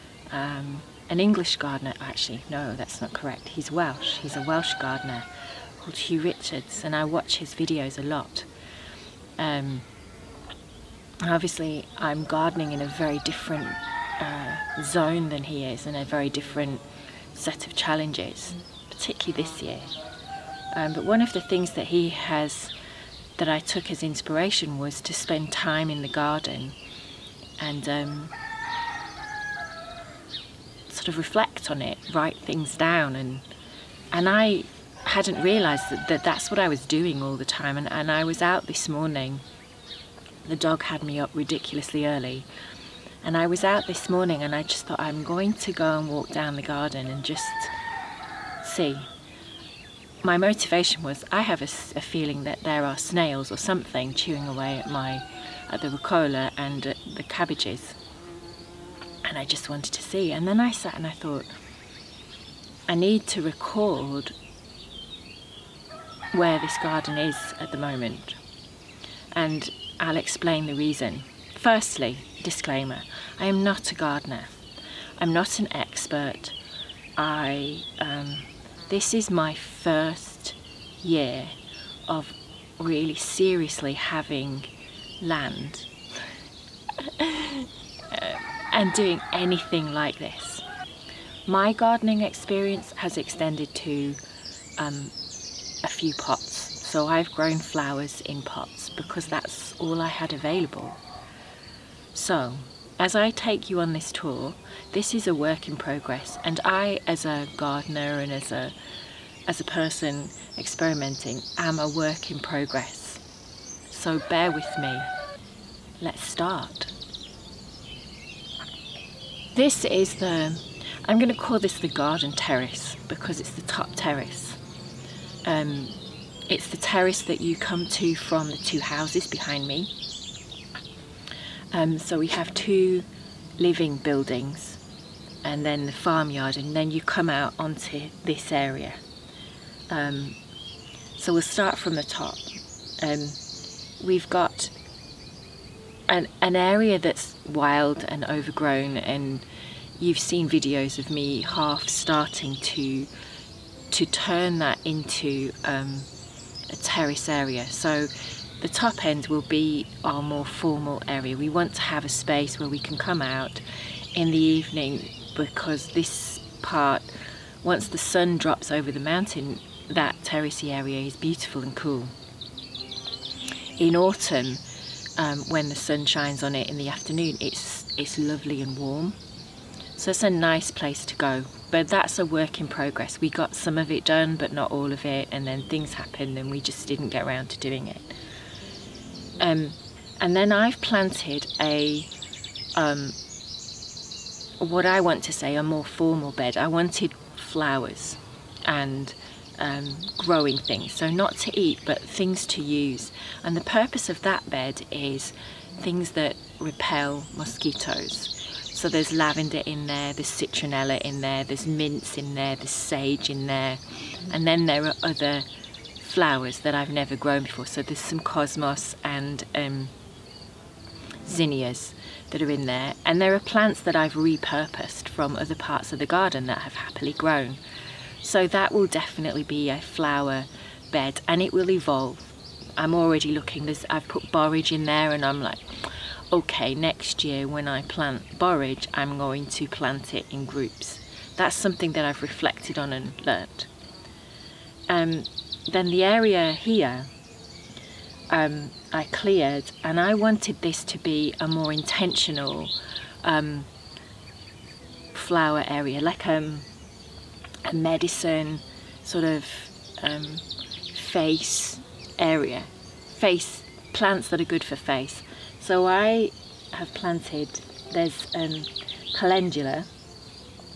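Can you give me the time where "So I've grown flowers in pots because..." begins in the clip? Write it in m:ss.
1:36.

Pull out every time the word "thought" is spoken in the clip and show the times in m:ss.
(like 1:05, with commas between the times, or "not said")
0:44, 1:01.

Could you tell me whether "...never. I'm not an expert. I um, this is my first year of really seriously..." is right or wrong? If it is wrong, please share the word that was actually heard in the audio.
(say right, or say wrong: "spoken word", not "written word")
wrong: "gardener", not "never".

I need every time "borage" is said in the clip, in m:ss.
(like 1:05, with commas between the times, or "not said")
3:54, 3:58.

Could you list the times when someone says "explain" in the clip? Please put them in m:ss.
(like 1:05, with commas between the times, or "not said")
1:10.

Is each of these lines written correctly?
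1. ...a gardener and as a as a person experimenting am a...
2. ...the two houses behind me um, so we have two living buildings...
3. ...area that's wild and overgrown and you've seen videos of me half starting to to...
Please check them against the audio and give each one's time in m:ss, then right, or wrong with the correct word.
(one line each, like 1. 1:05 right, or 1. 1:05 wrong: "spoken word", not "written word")
1. 1:47 right
2. 2:08 right
3. 2:26 right.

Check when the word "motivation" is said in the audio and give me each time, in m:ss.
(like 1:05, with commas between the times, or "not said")
0:50.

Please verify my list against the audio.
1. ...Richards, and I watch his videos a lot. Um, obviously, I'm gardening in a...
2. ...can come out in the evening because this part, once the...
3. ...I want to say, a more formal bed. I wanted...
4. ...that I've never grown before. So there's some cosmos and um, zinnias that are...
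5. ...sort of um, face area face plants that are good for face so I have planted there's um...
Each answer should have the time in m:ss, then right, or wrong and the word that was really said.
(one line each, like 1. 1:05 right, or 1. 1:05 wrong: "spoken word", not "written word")
1. 0:06 right
2. 2:42 right
3. 3:14 right
4. 3:36 right
5. 4:19 right.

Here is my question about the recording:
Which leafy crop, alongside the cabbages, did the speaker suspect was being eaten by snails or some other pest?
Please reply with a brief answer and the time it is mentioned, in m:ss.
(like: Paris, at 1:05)
Rucola, at 0:55.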